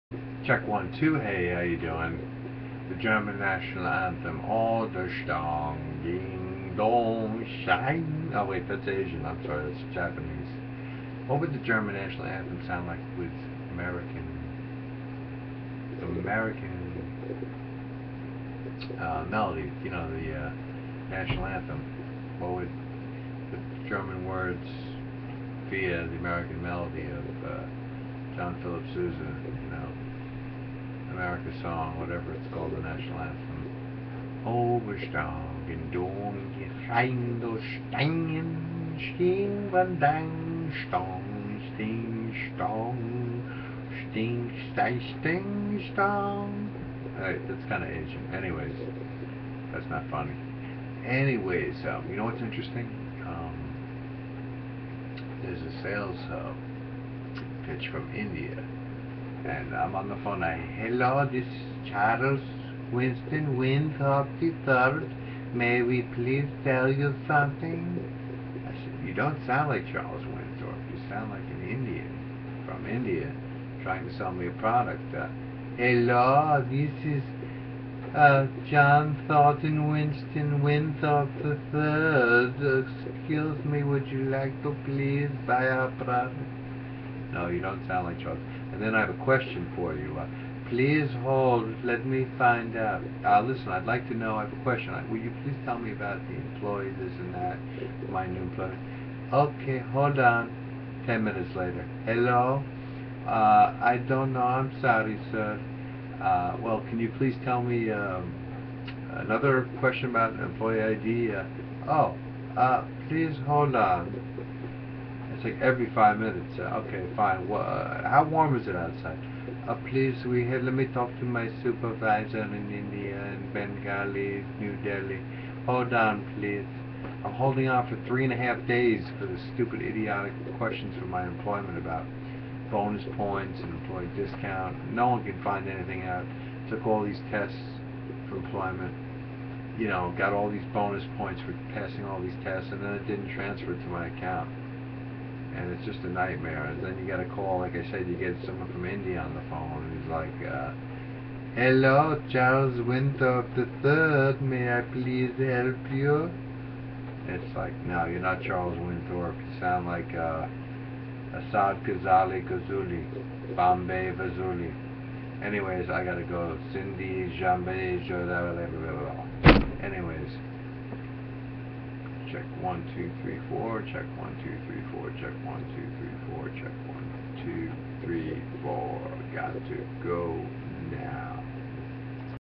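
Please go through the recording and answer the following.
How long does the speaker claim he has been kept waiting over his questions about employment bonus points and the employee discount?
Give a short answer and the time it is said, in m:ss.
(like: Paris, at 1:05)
3 and a half days, at 2:08.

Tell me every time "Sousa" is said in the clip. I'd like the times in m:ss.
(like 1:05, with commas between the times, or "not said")
0:28.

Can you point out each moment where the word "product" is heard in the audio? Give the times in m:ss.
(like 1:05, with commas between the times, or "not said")
1:14, 1:25.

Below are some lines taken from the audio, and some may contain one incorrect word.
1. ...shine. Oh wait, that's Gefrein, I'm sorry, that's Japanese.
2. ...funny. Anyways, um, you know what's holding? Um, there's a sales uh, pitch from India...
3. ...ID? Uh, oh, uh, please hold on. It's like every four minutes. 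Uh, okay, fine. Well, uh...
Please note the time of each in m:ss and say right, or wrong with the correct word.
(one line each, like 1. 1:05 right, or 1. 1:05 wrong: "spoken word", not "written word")
1. 0:07 wrong: "Asian", not "Gefrein"
2. 0:50 wrong: "interesting", not "holding"
3. 1:50 wrong: "five", not "four".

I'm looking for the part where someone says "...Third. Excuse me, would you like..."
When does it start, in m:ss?
1:21.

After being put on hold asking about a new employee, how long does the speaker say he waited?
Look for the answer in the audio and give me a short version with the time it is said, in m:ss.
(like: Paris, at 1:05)
10 minutes, at 1:41.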